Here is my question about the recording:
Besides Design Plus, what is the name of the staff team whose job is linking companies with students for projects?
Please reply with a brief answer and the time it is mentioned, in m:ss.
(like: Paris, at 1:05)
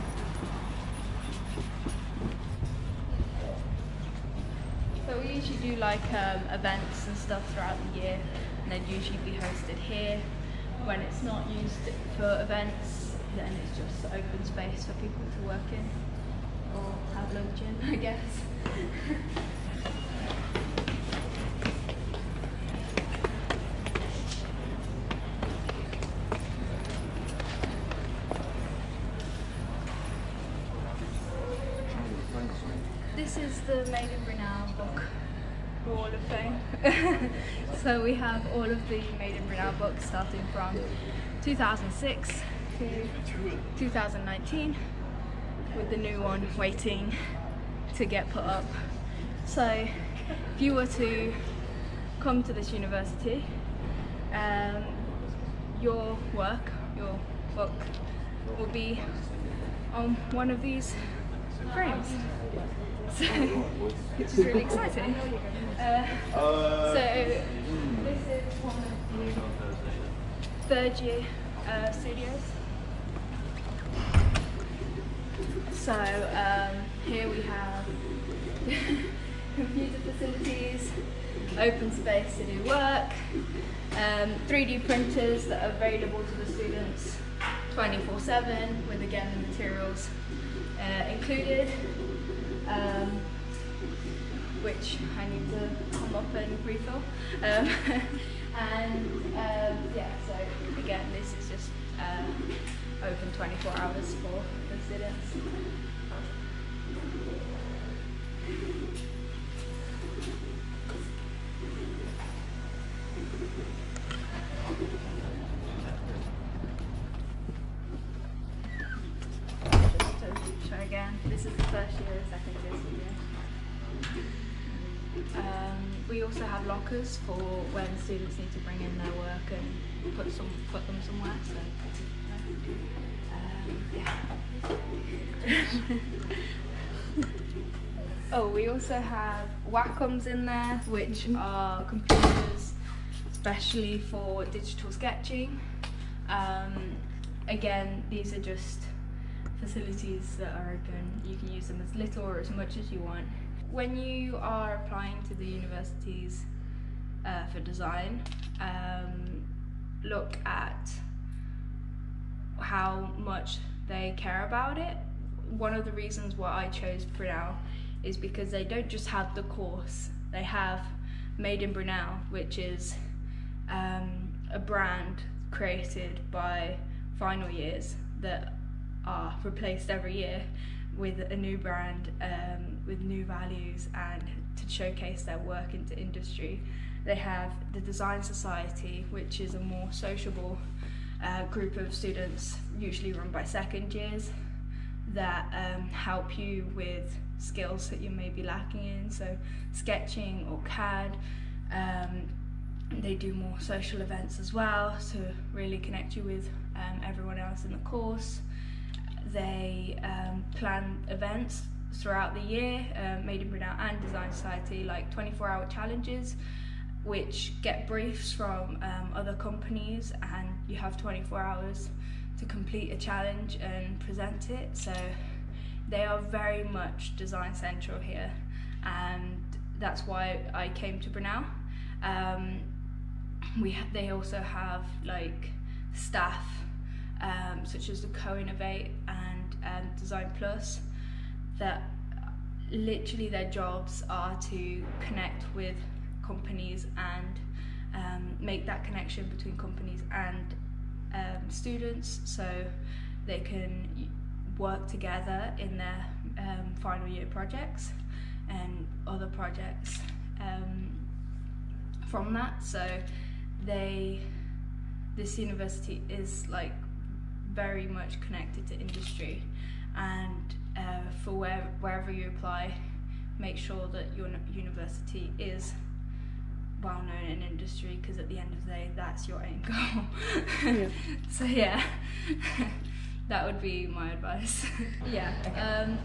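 Co-Innovate, at 3:58.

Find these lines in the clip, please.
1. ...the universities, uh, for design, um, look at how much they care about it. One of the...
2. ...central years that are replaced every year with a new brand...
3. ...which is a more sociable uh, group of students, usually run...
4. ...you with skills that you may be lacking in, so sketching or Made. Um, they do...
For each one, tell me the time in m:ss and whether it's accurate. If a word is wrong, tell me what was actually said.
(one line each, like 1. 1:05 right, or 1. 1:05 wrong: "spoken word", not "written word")
1. 2:35 right
2. 2:57 wrong: "final", not "central"
3. 3:09 right
4. 3:16 wrong: "CAD", not "Made".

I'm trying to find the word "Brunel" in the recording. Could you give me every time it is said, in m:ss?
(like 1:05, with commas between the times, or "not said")
0:39, 2:47, 2:51, 3:33, 3:51.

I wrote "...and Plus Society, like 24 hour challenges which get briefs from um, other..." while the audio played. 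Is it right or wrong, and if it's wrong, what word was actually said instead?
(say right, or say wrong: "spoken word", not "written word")
wrong: "Design", not "Plus".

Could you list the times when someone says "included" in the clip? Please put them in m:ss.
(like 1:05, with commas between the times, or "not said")
1:31.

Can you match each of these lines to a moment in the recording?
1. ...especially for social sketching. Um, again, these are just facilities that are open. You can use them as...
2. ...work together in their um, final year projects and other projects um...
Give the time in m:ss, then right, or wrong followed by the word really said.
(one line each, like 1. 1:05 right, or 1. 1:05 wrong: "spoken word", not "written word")
1. 2:23 wrong: "digital", not "social"
2. 4:14 right.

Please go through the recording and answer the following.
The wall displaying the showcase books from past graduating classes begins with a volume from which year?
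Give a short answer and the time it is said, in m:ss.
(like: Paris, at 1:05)
2006, at 0:41.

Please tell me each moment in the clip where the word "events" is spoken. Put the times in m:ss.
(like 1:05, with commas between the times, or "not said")
0:06, 0:12, 3:24, 3:31.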